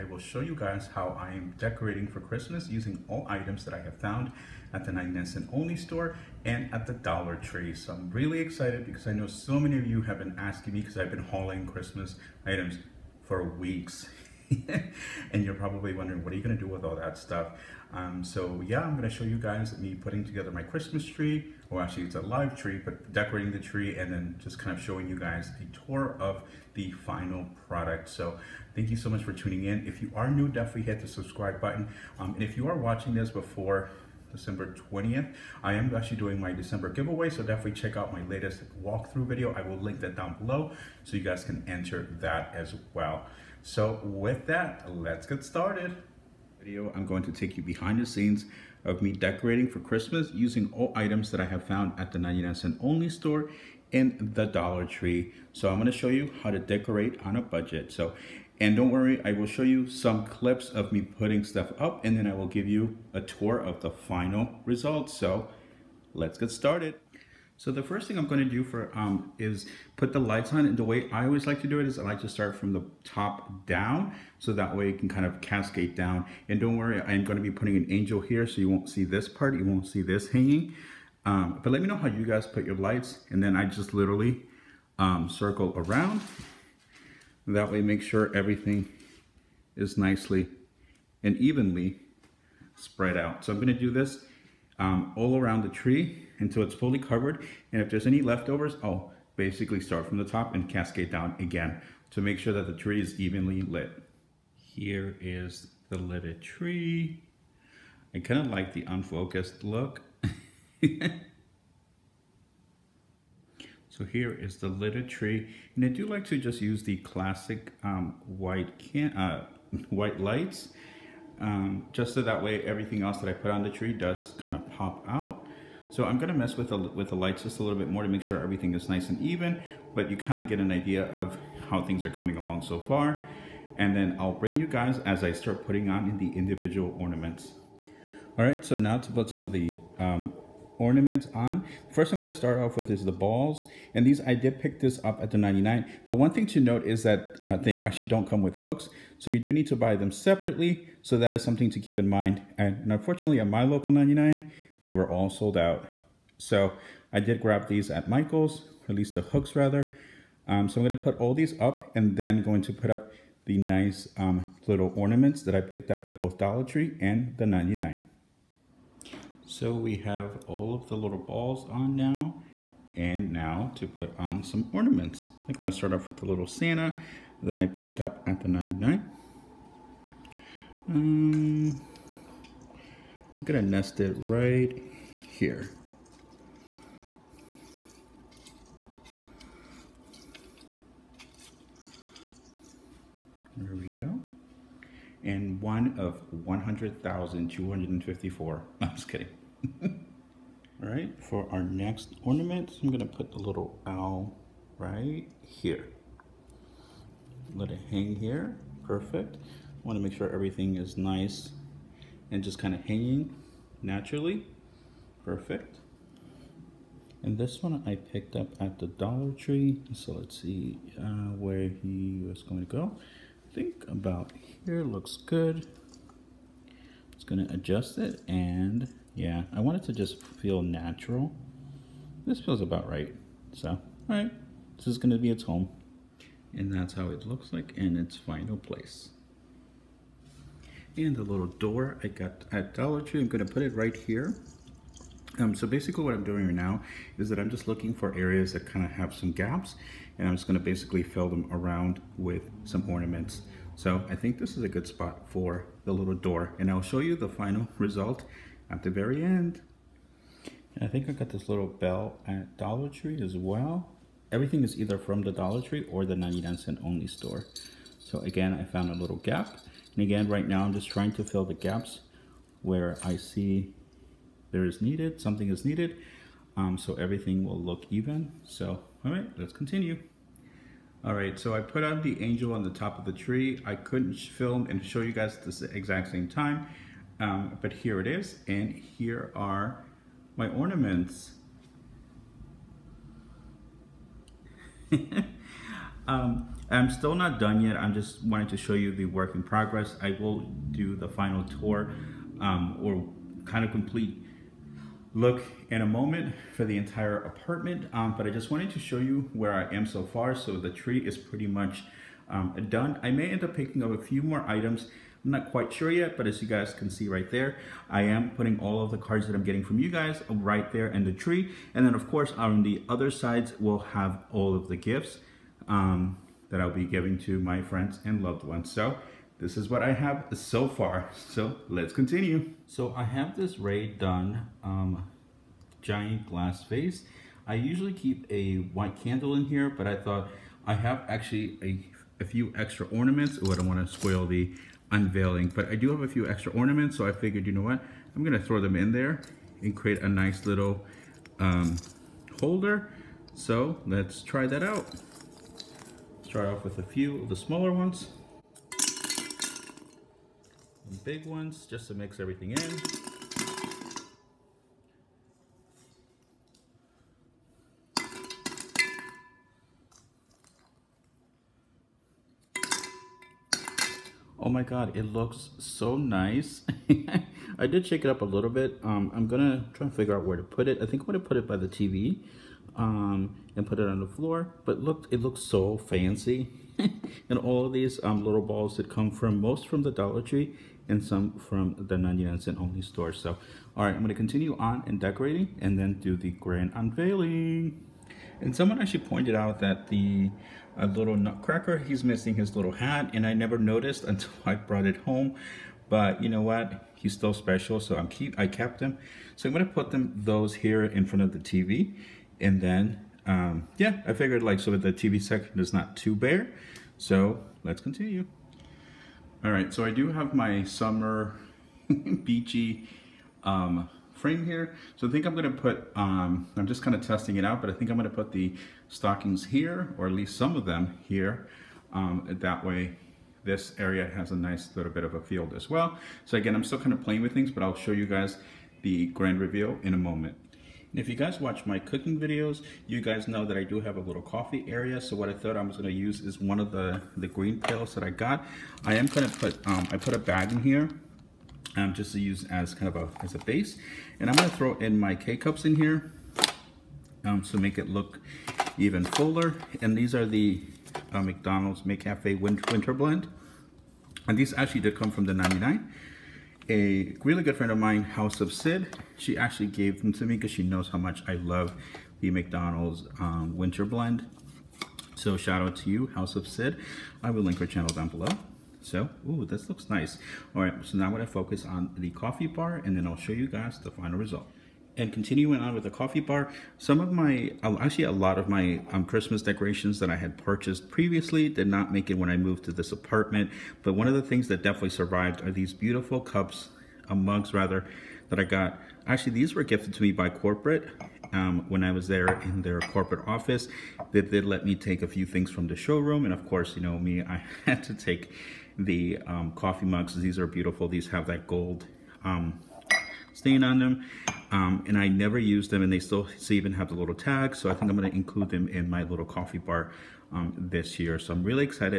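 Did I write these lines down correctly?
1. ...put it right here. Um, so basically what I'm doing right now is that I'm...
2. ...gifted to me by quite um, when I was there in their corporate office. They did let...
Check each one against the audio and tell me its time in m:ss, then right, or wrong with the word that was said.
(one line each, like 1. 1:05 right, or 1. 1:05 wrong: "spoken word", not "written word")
1. 4:03 right
2. 8:19 wrong: "corporate", not "quite".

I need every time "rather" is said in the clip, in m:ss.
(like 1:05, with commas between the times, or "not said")
2:39, 8:17.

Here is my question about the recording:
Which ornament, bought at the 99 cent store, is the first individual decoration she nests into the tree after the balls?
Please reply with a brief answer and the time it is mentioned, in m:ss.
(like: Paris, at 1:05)
Santa, at 2:56.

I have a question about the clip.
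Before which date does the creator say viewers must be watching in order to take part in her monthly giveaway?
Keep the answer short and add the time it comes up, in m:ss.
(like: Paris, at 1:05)
December 20th, at 0:34.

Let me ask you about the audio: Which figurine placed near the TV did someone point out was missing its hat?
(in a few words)
Nutcracker.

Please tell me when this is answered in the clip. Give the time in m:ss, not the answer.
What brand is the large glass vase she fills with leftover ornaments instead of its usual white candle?
5:33.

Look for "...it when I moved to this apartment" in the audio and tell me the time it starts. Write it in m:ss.
8:12.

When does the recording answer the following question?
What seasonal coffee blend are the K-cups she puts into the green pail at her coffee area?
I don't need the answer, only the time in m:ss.
7:41.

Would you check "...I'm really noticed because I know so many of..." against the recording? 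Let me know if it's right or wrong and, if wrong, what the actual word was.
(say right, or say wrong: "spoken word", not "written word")
wrong: "excited", not "noticed".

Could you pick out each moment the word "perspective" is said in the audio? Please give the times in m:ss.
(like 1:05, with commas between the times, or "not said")
not said.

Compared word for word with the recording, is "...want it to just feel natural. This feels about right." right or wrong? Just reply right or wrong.
right.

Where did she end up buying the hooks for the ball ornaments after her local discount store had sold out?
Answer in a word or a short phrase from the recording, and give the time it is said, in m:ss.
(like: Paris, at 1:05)
Michael's, at 2:38.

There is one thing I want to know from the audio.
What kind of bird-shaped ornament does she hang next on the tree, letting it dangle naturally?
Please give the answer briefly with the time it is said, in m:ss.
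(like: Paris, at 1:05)
Owl, at 3:23.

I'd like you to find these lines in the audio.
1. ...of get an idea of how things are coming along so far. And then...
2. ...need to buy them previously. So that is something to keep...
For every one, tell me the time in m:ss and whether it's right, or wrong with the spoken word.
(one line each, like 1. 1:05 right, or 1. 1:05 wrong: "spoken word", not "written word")
1. 2:10 right
2. 2:29 wrong: "separately", not "previously".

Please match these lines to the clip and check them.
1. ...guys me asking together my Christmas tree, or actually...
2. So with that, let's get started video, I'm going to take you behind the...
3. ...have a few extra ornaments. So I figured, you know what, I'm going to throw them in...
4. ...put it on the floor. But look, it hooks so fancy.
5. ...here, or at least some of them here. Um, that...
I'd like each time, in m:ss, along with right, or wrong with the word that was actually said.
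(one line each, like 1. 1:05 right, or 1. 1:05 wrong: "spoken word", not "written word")
1. 0:19 wrong: "putting", not "asking"
2. 0:43 right
3. 5:45 right
4. 6:23 wrong: "looks", not "hooks"
5. 7:09 right.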